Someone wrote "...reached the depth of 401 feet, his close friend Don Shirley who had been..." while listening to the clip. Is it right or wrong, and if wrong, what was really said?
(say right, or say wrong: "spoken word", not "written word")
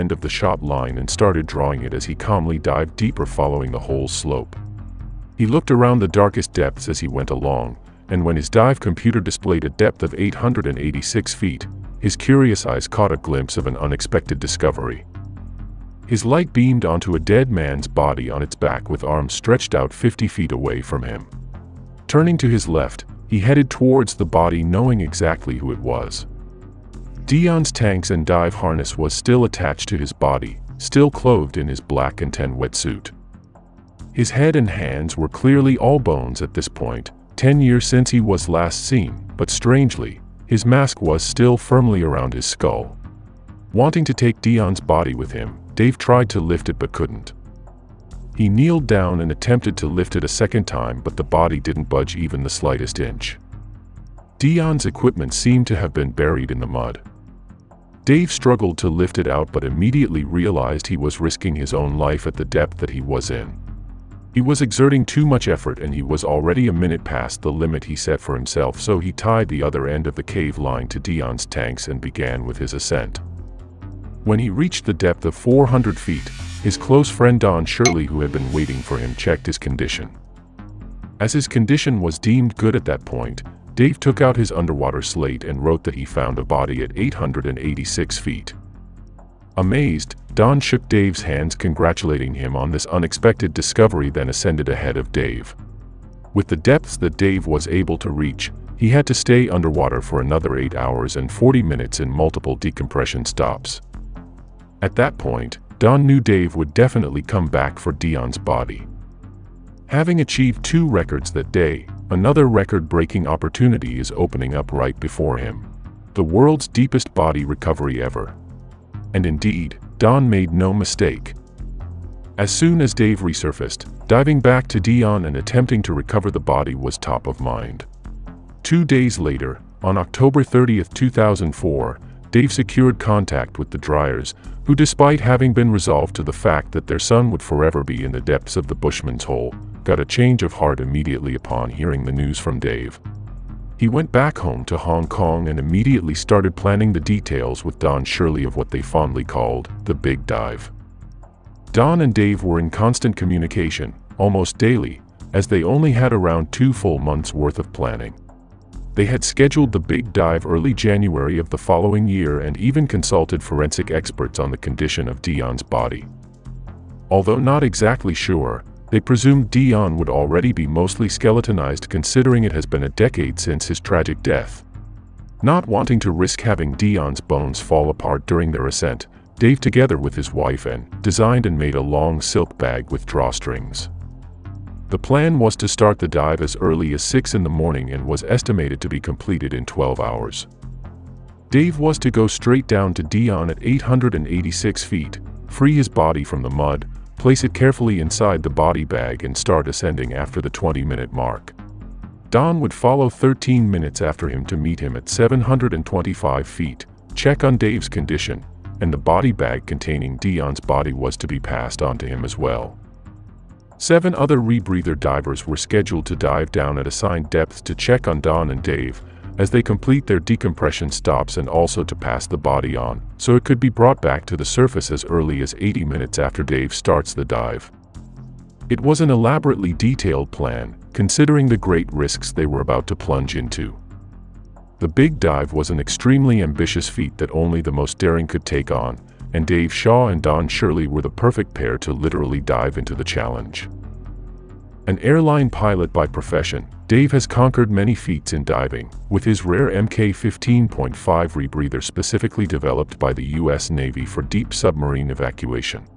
wrong: "400", not "401".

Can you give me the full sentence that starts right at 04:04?
An airline pilot by profession, Dave has conquered many feats in diving, with his rare MK-15.5 rebreather specifically developed by the U.S.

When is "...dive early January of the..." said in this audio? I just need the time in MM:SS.
02:40.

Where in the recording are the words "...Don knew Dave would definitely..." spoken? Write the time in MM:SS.
01:45.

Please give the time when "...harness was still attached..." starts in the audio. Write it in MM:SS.
00:28.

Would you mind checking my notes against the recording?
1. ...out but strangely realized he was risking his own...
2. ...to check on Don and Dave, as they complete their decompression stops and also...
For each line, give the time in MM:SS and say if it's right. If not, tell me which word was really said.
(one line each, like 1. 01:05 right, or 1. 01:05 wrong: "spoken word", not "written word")
1. 00:59 wrong: "immediately", not "strangely"
2. 03:37 right.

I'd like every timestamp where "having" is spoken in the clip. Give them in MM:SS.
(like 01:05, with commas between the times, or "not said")
01:49, 02:15, 02:56.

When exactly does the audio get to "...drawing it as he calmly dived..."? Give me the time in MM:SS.
00:01.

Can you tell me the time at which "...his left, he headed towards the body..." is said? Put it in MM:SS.
00:22.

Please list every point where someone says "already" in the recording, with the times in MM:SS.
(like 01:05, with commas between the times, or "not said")
01:06, 02:50.